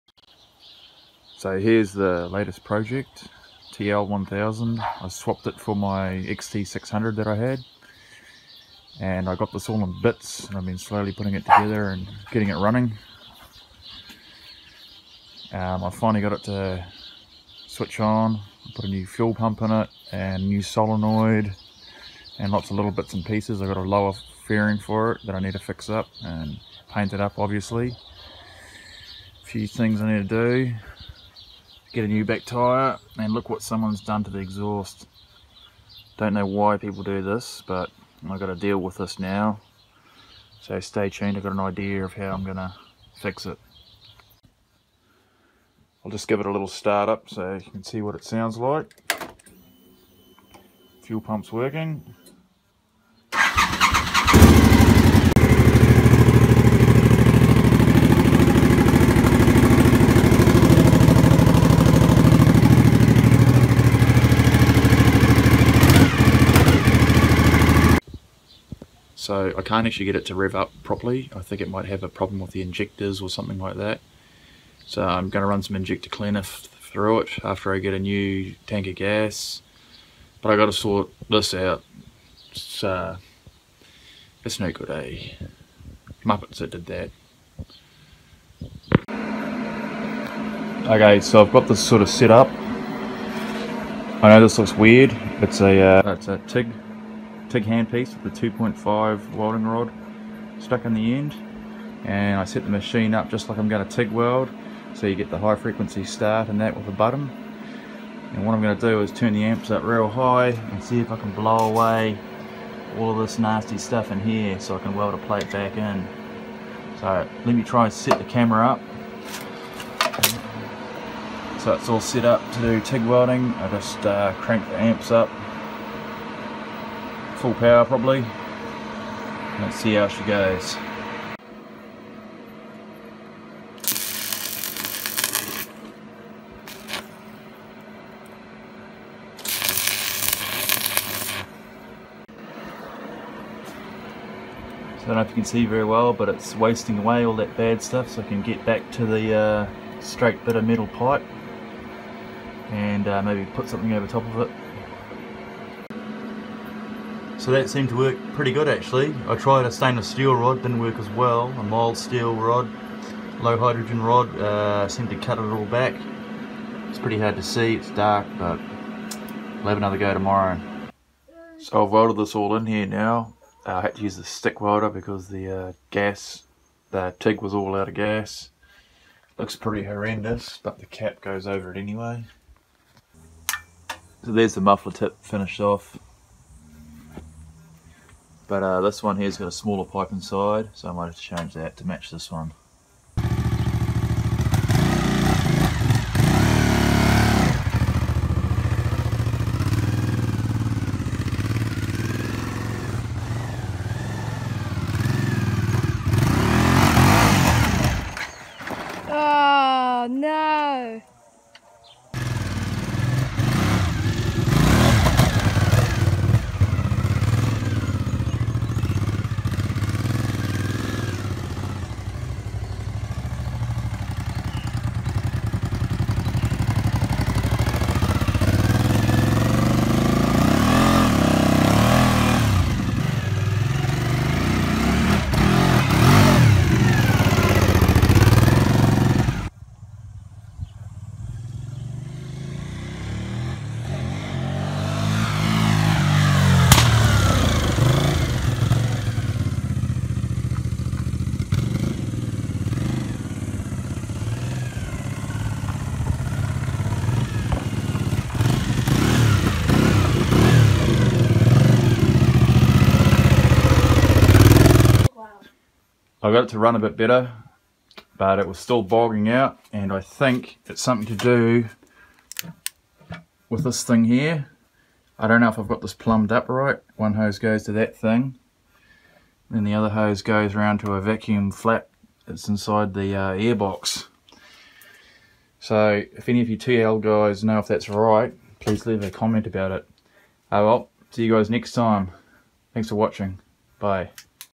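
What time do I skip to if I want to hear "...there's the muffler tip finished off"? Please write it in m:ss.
3:04.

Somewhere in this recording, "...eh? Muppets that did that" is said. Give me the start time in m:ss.
1:24.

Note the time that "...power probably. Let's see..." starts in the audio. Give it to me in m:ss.
2:07.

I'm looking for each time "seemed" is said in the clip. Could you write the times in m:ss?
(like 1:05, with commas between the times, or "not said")
2:37, 2:44.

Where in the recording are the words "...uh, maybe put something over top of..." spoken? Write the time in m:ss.
2:33.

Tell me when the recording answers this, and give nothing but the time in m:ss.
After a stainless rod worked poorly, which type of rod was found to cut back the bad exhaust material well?
2:43.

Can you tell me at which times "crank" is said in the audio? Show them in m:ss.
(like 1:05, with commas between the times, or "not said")
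2:04.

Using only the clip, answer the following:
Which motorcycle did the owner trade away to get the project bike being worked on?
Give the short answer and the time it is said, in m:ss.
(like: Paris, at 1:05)
XT600, at 0:06.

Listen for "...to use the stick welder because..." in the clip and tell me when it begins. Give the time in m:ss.
2:53.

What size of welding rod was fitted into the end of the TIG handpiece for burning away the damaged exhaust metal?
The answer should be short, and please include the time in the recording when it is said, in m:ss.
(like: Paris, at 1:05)
2.5, at 1:38.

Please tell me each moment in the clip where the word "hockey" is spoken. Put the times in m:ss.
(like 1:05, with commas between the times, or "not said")
not said.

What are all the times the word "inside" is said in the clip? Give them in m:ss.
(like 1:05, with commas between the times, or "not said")
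3:10, 4:42.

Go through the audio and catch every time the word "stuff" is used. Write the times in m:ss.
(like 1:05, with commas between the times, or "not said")
1:53, 2:27.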